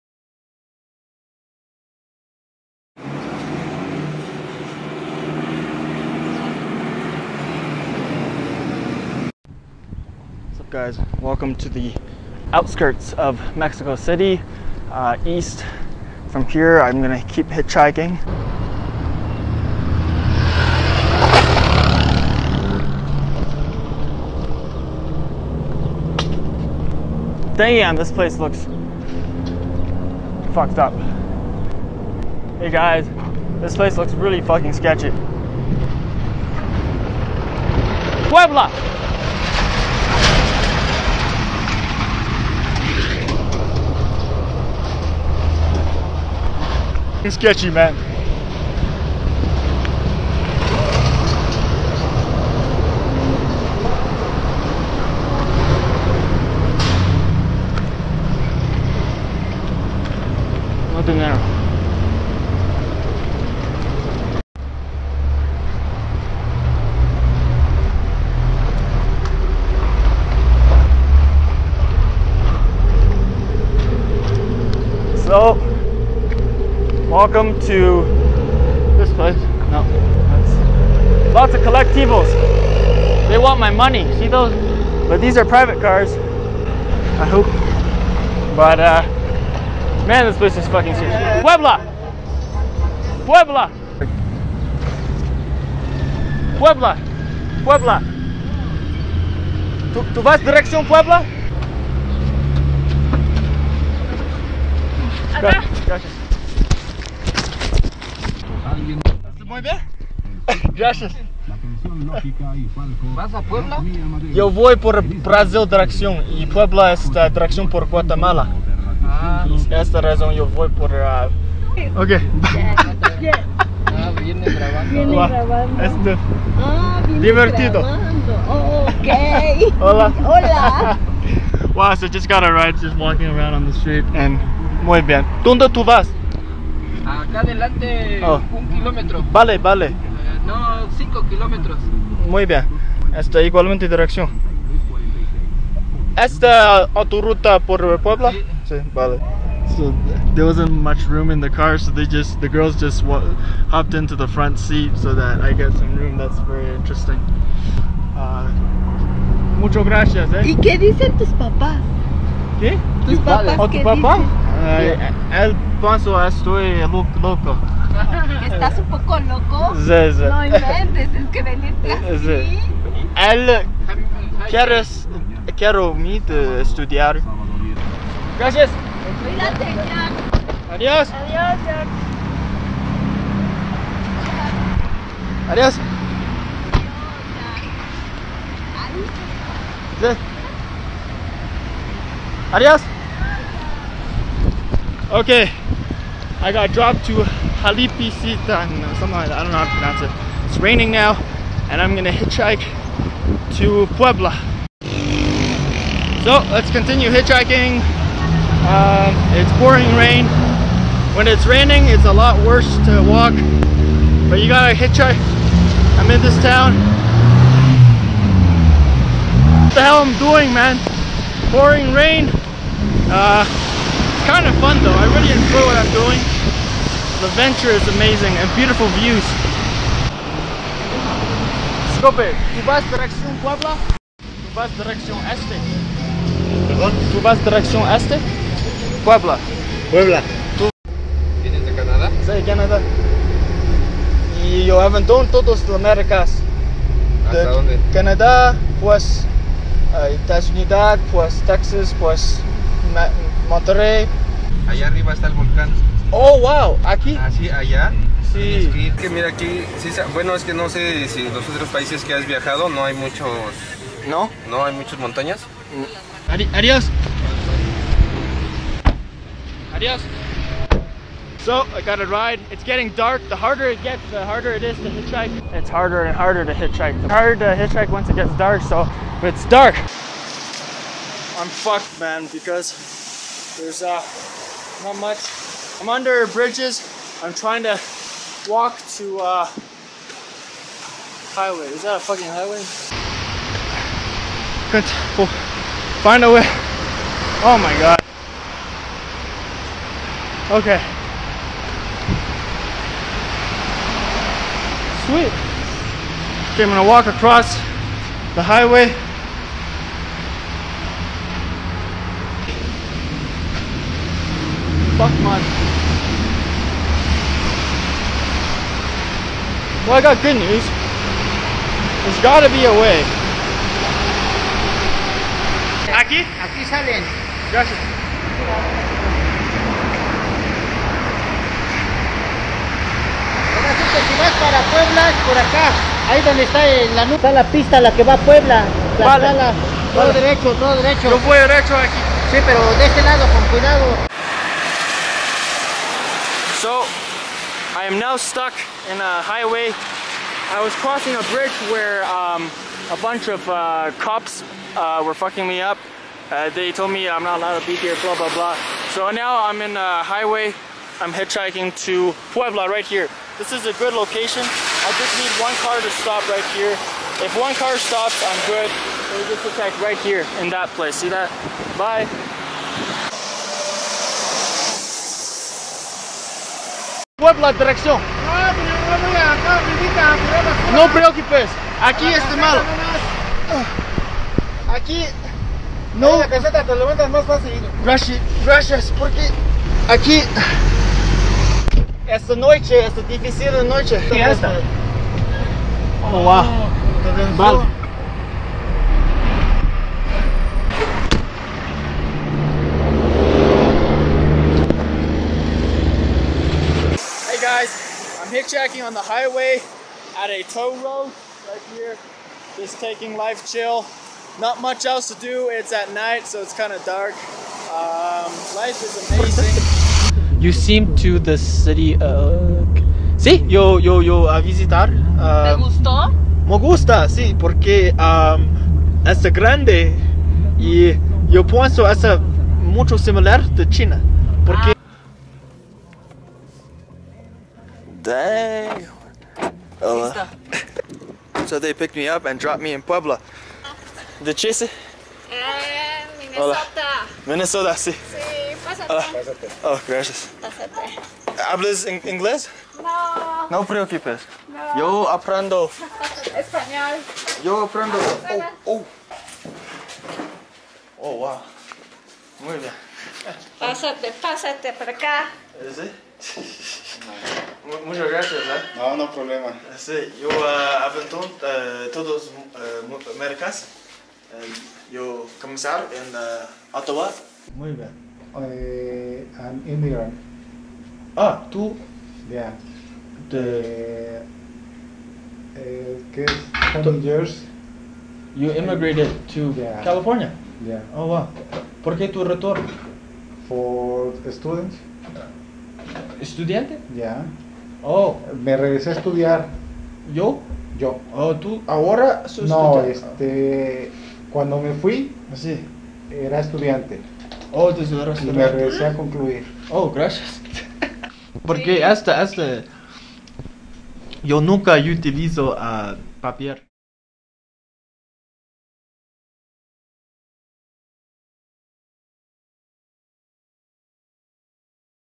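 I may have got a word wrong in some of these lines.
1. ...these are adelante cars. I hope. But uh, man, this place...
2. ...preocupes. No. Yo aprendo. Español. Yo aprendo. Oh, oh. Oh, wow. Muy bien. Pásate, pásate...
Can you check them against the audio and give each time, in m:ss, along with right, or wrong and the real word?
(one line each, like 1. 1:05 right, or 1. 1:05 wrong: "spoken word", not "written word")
1. 1:25 wrong: "private", not "adelante"
2. 7:33 right.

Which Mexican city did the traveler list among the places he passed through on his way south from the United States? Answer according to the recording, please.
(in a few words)
Monterrey.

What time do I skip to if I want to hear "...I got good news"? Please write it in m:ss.
5:19.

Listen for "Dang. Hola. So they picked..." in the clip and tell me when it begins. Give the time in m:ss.
7:18.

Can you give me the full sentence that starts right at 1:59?
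Ah, esta razón yo voy por...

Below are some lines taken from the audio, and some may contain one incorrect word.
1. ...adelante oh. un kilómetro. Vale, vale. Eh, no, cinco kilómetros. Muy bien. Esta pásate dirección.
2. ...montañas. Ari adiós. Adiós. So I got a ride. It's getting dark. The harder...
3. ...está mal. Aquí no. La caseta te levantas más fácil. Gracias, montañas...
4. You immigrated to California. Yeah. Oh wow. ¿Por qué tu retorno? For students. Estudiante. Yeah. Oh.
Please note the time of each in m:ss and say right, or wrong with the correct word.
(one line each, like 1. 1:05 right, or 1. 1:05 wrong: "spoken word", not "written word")
1. 2:17 wrong: "igualmente", not "pásate"
2. 4:24 right
3. 6:22 wrong: "gracias", not "montañas"
4. 8:08 right.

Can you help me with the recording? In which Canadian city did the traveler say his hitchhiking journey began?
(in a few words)
Ottawa.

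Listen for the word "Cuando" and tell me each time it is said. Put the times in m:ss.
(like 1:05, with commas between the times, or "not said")
8:24.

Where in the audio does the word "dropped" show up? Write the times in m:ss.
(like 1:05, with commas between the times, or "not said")
3:16, 7:22.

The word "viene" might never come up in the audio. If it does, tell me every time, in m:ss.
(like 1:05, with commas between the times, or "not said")
2:04, 4:01.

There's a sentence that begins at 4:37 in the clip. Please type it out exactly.
It's harder to hitchhike once it gets dark, so it's dark.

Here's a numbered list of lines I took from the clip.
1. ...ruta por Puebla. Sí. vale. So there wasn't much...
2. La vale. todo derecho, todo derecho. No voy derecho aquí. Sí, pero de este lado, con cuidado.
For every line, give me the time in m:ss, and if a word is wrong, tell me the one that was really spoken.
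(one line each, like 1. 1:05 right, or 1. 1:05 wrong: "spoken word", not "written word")
1. 2:27 right
2. 5:38 right.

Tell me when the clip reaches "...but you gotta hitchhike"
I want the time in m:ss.
3:34.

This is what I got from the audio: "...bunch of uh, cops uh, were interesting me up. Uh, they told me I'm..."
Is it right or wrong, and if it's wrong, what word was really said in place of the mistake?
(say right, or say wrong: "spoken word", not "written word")
wrong: "fucking", not "interesting".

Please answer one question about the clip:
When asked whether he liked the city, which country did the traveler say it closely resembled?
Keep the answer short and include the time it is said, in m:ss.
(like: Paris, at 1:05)
China, at 7:13.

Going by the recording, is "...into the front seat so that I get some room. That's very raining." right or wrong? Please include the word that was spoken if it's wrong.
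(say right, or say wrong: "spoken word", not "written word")
wrong: "interesting", not "raining".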